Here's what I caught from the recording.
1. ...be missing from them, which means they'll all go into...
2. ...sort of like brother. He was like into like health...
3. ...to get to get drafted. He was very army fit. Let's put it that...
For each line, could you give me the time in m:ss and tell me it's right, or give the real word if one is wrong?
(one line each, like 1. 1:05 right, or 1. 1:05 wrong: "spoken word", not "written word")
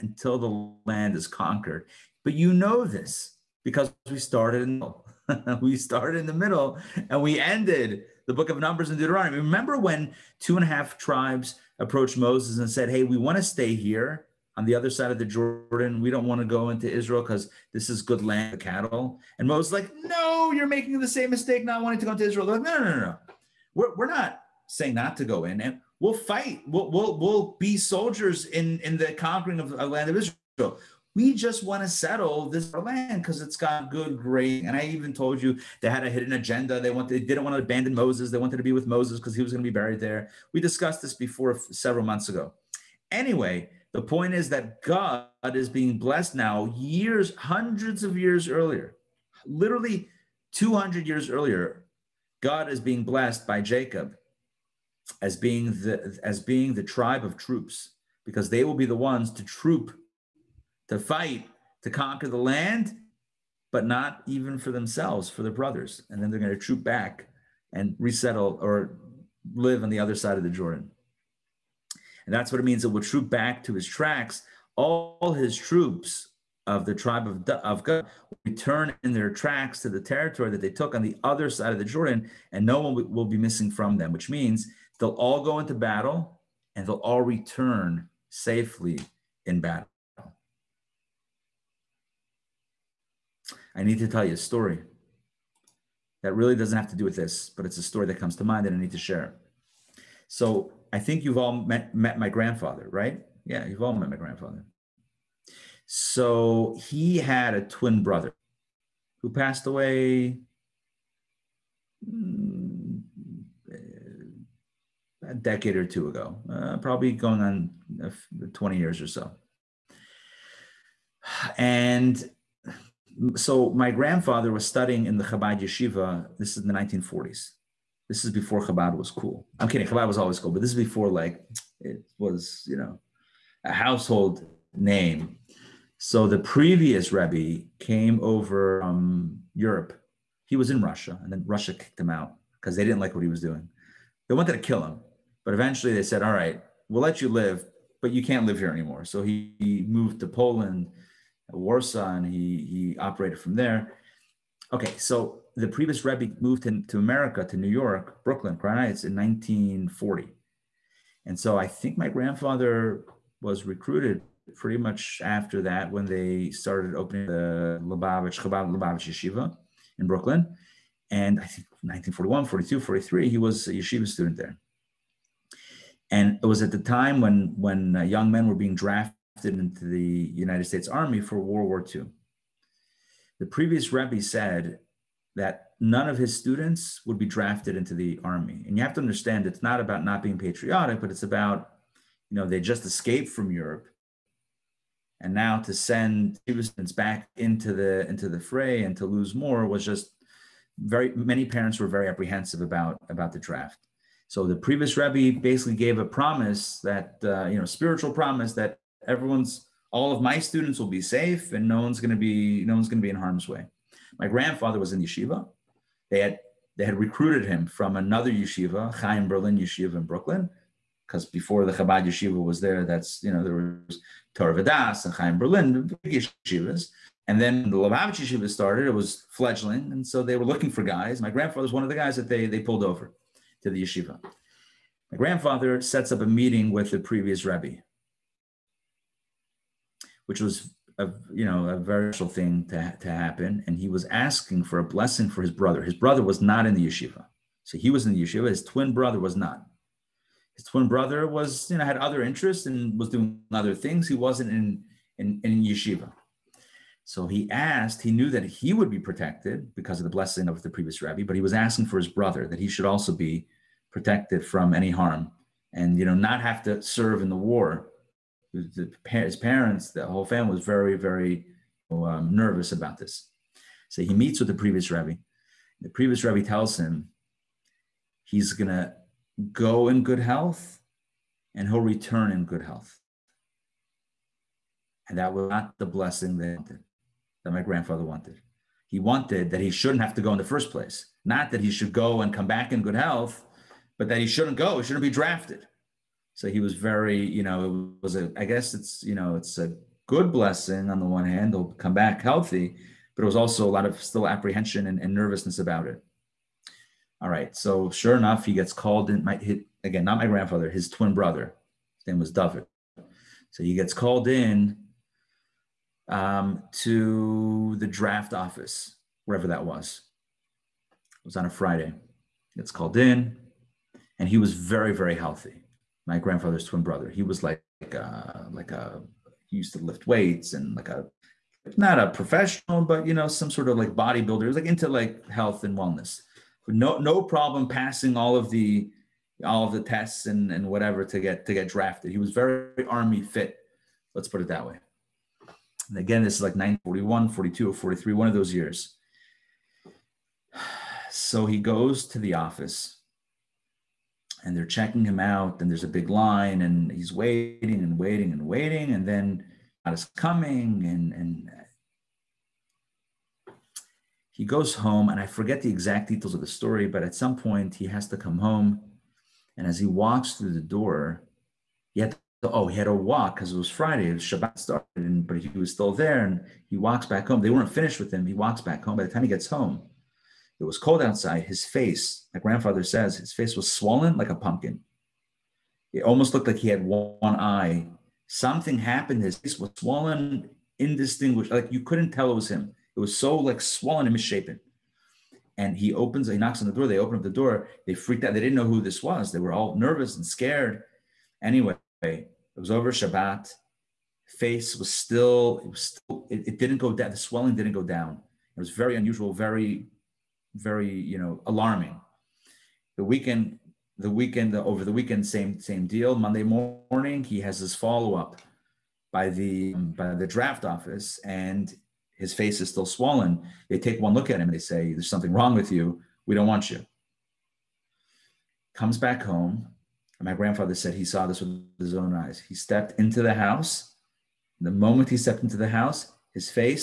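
1. 1:23 right
2. 5:33 wrong: "bodybuilder", not "brother"
3. 5:41 right.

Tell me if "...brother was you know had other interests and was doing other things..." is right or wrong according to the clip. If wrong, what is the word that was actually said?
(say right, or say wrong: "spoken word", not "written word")
right.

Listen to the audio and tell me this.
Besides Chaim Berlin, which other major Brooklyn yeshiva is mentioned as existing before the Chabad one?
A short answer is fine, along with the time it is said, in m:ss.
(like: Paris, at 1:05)
Torah Vodaas, at 3:44.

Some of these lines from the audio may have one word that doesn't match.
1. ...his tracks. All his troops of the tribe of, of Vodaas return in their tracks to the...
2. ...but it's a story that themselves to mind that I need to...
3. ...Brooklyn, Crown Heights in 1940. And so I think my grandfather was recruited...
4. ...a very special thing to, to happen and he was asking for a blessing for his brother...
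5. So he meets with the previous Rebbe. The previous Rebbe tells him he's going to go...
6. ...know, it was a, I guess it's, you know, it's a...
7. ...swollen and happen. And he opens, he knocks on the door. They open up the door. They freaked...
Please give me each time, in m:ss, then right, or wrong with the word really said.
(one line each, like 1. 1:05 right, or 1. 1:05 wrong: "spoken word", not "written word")
1. 1:13 wrong: "Gad", not "Vodaas"
2. 1:37 wrong: "comes", not "themselves"
3. 2:38 right
4. 4:01 right
5. 4:33 right
6. 4:57 right
7. 6:33 wrong: "misshapen", not "happen".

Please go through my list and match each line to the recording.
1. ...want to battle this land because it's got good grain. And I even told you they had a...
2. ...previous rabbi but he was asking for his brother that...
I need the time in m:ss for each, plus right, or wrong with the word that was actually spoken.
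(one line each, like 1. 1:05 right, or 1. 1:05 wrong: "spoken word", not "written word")
1. 0:31 wrong: "settle", not "battle"
2. 4:20 right.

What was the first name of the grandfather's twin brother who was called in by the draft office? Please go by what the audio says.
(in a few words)
David.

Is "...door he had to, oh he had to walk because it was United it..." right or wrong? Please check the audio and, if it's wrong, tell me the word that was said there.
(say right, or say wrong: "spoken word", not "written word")
wrong: "Friday", not "United".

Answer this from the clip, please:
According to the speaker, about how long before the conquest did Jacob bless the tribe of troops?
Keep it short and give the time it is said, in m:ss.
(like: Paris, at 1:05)
200 years, at 0:50.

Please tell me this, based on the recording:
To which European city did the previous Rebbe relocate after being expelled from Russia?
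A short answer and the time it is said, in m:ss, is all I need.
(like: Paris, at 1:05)
Warsaw, at 2:31.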